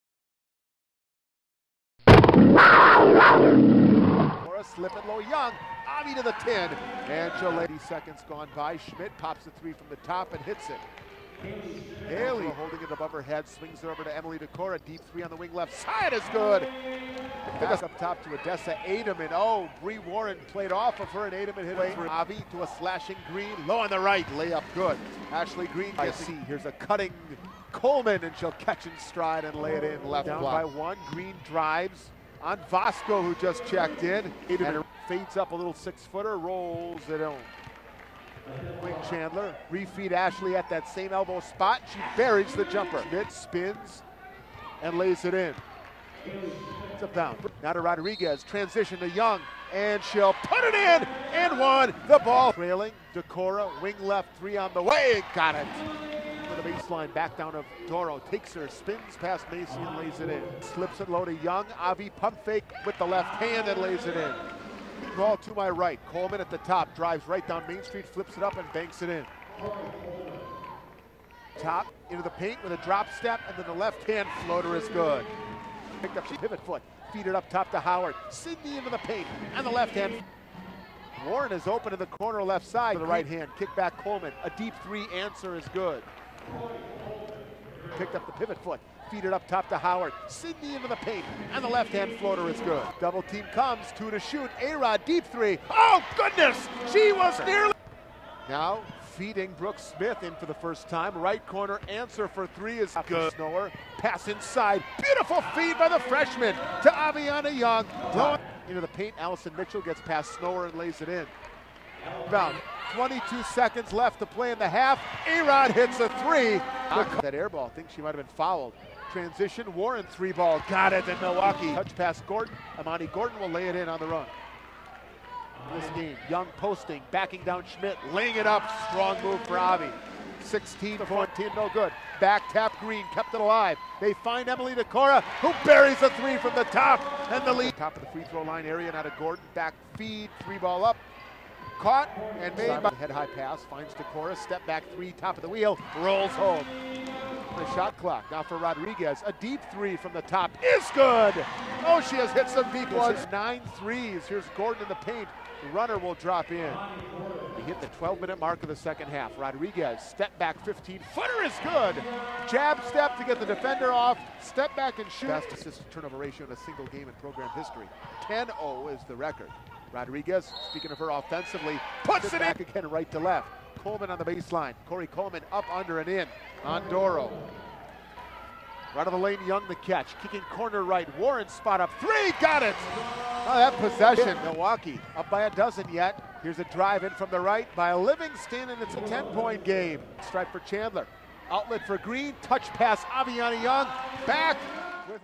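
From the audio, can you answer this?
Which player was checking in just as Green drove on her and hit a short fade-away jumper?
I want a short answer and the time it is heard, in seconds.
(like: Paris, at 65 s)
Vasco, at 32 s.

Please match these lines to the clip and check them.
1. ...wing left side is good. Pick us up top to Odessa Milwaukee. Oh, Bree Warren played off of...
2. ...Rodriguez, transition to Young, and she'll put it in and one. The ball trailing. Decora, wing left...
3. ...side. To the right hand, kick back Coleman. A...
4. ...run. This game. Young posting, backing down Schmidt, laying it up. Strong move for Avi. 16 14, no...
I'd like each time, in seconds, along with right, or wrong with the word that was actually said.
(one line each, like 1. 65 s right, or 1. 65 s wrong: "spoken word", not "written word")
1. 15 s wrong: "Ademan", not "Milwaukee"
2. 47 s right
3. 82 s right
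4. 124 s right.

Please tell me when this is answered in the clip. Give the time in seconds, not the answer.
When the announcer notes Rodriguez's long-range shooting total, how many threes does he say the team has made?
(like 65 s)
153 s.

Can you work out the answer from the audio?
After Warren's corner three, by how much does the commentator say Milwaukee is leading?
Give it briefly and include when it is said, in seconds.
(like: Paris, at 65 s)
12 points, at 185 s.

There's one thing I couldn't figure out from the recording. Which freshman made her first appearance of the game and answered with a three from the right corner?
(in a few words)
Brooke Smith.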